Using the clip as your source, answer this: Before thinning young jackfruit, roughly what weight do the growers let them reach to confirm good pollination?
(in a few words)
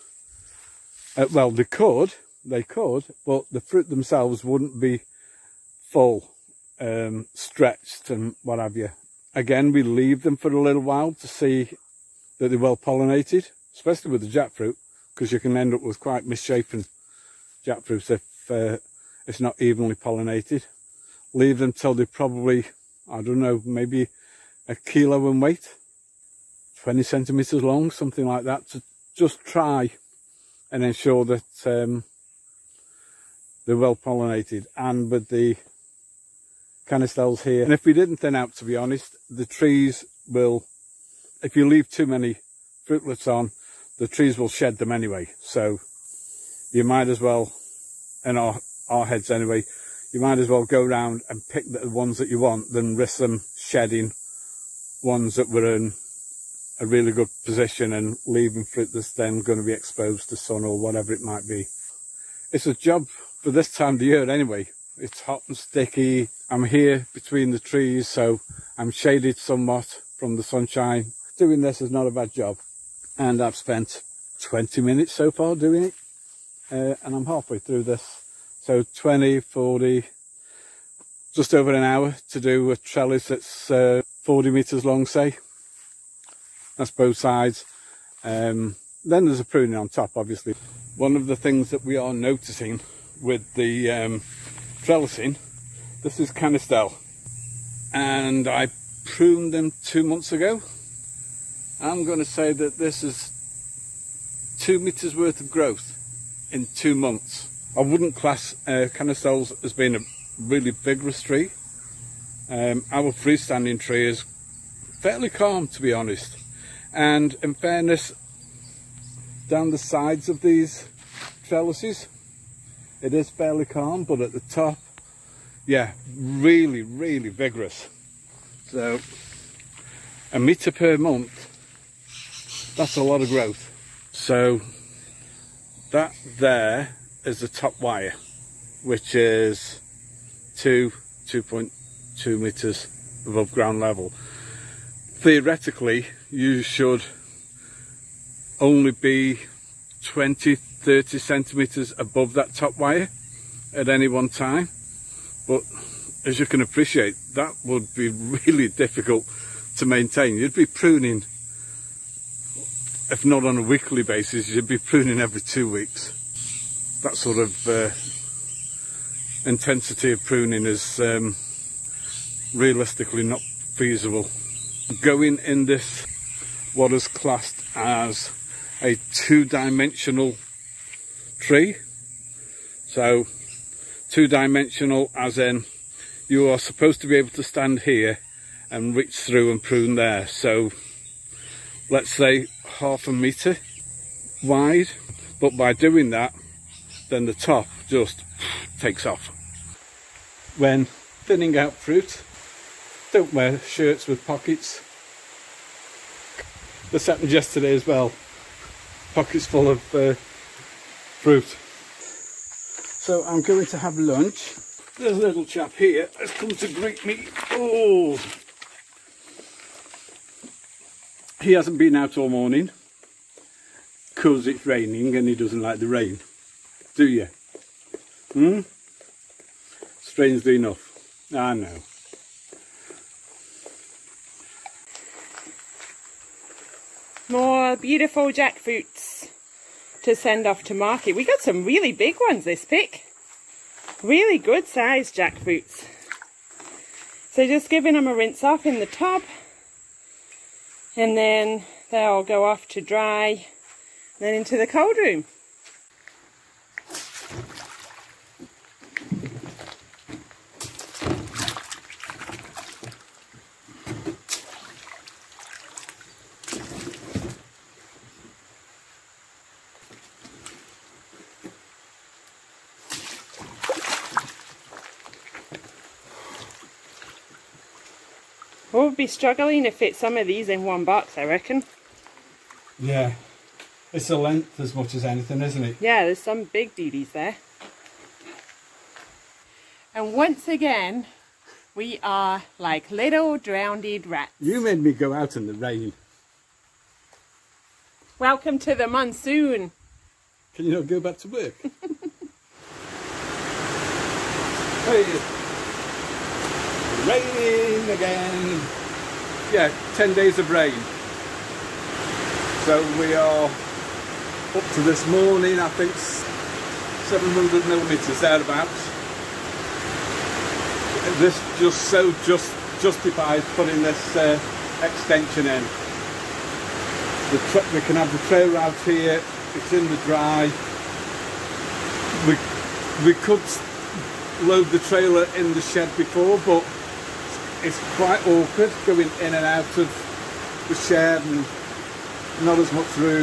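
1 kilo.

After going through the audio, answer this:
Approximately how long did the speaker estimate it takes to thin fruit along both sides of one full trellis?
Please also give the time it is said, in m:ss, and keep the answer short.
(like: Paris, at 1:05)
just over an hour, at 1:21.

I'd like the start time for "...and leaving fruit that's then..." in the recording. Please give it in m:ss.
0:57.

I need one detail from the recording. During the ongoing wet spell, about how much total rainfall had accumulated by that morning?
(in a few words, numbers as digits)
700 millimeters.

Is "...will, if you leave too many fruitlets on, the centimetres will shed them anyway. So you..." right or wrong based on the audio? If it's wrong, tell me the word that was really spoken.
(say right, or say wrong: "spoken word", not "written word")
wrong: "trees", not "centimetres".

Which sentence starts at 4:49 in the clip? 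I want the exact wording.
And once again, we are like little drowned rats.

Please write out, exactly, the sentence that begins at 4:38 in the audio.
We'll be struggling to fit some of these in one box, I reckon.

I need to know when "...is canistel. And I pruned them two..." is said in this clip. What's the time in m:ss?
1:36.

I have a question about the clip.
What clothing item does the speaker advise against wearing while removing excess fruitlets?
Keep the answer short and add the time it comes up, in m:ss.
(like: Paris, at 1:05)
shirts with pockets, at 3:23.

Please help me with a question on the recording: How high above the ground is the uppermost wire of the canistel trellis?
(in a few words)
2.2 meters.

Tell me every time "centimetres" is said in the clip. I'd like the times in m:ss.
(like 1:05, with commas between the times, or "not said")
0:27, 2:31.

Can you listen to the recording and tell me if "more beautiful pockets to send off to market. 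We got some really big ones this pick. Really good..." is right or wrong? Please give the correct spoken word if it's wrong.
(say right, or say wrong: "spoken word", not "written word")
wrong: "jackfruits", not "pockets".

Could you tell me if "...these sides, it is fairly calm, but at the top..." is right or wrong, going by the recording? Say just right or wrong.
wrong.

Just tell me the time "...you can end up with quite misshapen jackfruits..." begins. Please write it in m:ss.
0:15.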